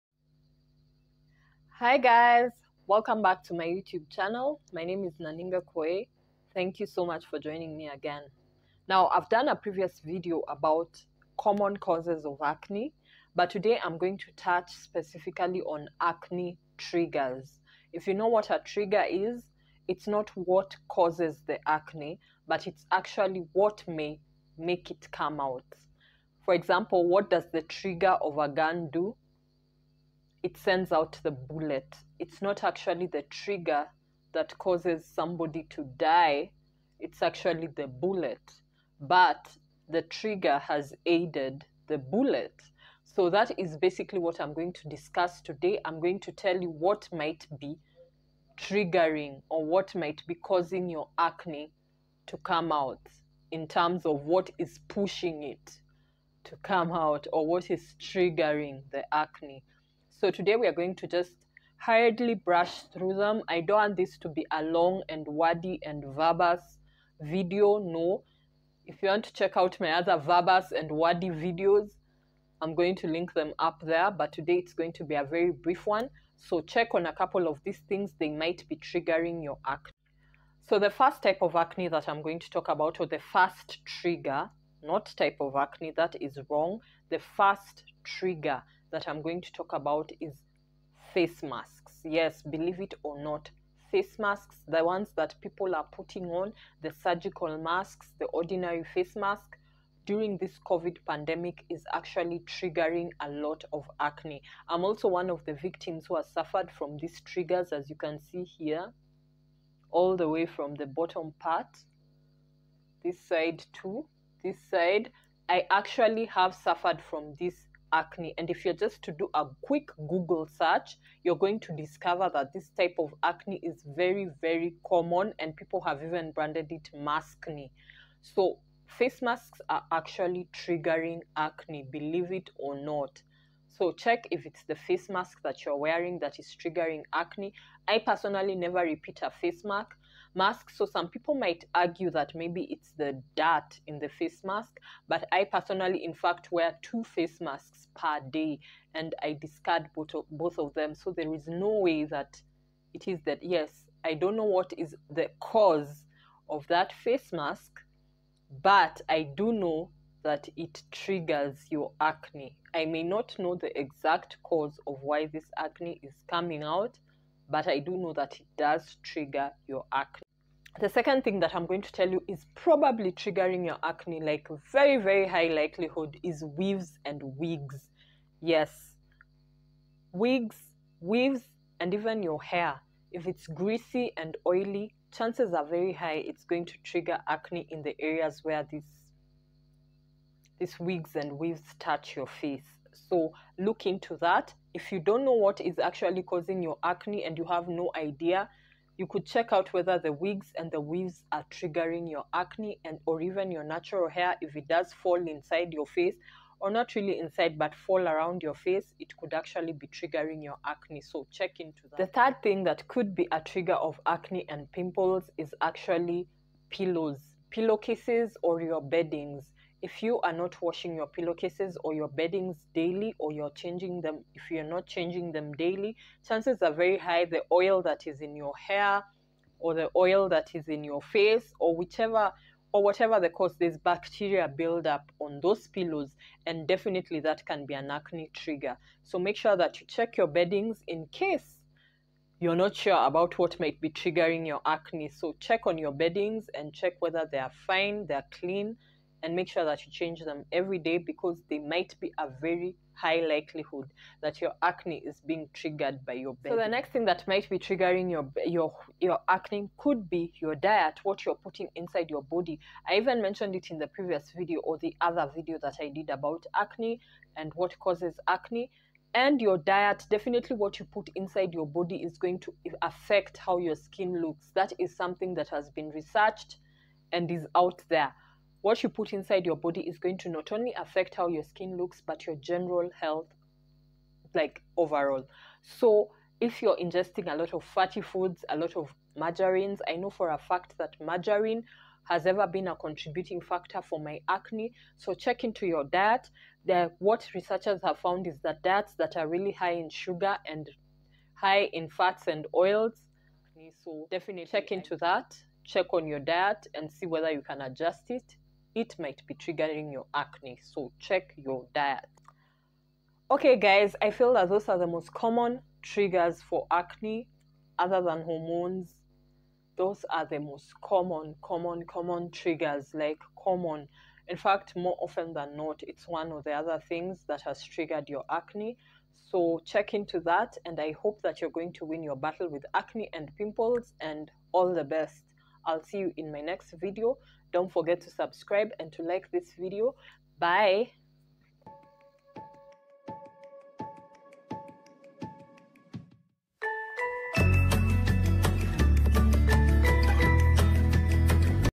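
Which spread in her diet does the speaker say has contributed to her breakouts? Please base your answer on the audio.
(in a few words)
margarine.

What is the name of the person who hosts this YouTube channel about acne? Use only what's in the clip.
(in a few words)
Naninga Koe.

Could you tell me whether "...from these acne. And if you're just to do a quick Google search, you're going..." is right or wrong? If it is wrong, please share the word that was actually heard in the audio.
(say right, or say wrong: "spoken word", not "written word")
right.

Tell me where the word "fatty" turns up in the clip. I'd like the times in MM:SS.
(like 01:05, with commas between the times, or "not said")
04:47.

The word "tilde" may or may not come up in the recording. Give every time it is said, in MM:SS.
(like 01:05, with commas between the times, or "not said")
not said.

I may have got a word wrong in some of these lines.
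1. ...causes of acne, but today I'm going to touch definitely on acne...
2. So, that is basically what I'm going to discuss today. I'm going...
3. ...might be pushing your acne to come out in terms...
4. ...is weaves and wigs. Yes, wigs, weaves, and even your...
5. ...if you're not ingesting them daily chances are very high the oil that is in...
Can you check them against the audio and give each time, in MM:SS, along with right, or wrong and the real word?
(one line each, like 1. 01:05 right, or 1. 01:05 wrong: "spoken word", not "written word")
1. 00:11 wrong: "specifically", not "definitely"
2. 00:43 right
3. 00:49 wrong: "causing", not "pushing"
4. 02:56 right
5. 03:44 wrong: "changing", not "ingesting".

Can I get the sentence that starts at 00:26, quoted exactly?
For example, what does the trigger of a gun do?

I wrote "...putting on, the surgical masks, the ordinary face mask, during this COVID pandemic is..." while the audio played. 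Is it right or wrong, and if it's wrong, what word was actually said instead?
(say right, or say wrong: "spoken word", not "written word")
right.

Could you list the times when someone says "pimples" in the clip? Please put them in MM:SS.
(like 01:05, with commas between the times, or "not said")
03:34, 05:33.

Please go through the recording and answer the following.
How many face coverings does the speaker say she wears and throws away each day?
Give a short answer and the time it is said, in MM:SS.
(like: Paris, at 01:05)
2, at 02:26.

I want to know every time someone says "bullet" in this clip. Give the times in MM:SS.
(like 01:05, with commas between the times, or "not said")
00:31, 00:37, 00:41.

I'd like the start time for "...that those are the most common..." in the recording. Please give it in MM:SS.
05:14.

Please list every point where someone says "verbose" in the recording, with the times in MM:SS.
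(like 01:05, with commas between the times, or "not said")
01:06, 01:10.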